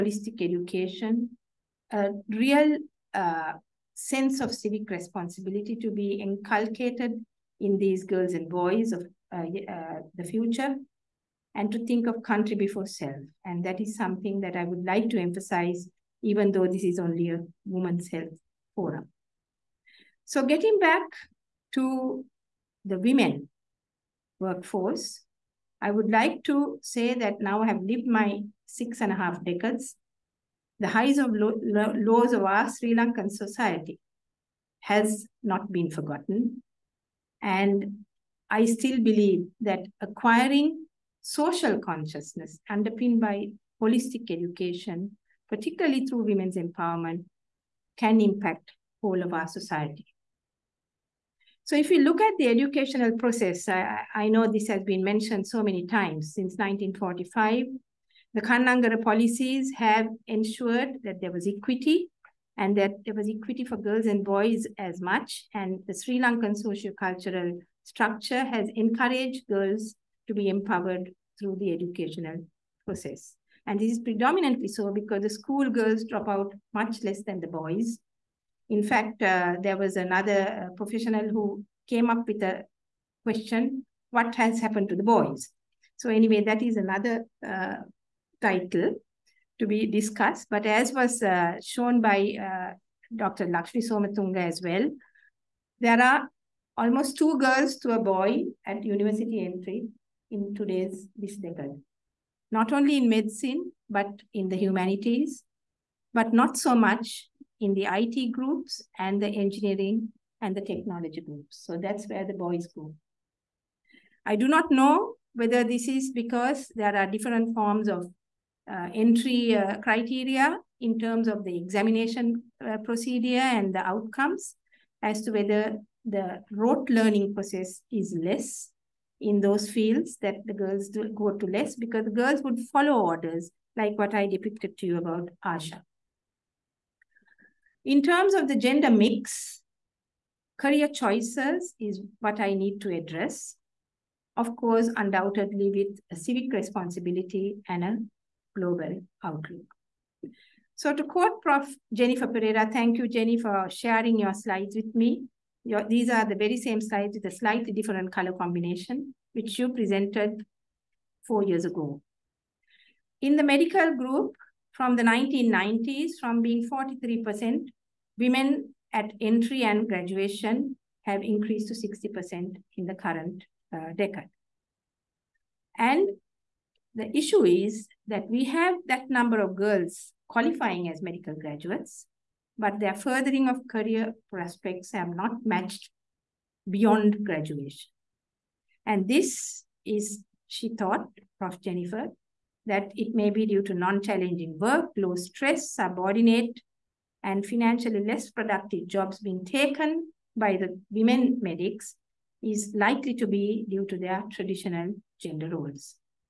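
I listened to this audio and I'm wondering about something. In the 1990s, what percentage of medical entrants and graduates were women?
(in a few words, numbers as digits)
43%.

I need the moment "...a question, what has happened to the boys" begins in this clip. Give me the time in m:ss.
1:22.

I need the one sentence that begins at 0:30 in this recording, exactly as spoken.
The highs of lo lo lows of our Sri Lankan society has not been forgotten.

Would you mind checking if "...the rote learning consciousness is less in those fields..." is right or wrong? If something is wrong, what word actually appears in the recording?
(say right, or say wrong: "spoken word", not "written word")
wrong: "process", not "consciousness".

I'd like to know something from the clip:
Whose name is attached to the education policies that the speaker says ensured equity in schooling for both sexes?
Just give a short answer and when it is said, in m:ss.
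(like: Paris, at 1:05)
Kannangara, at 0:58.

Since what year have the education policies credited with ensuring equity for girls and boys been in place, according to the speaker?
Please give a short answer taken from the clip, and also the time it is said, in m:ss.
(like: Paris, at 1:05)
1945, at 0:56.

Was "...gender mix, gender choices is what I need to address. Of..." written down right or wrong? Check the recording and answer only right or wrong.
wrong.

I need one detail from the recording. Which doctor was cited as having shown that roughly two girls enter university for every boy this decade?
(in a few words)
Dr. Lakshmi Somatunga.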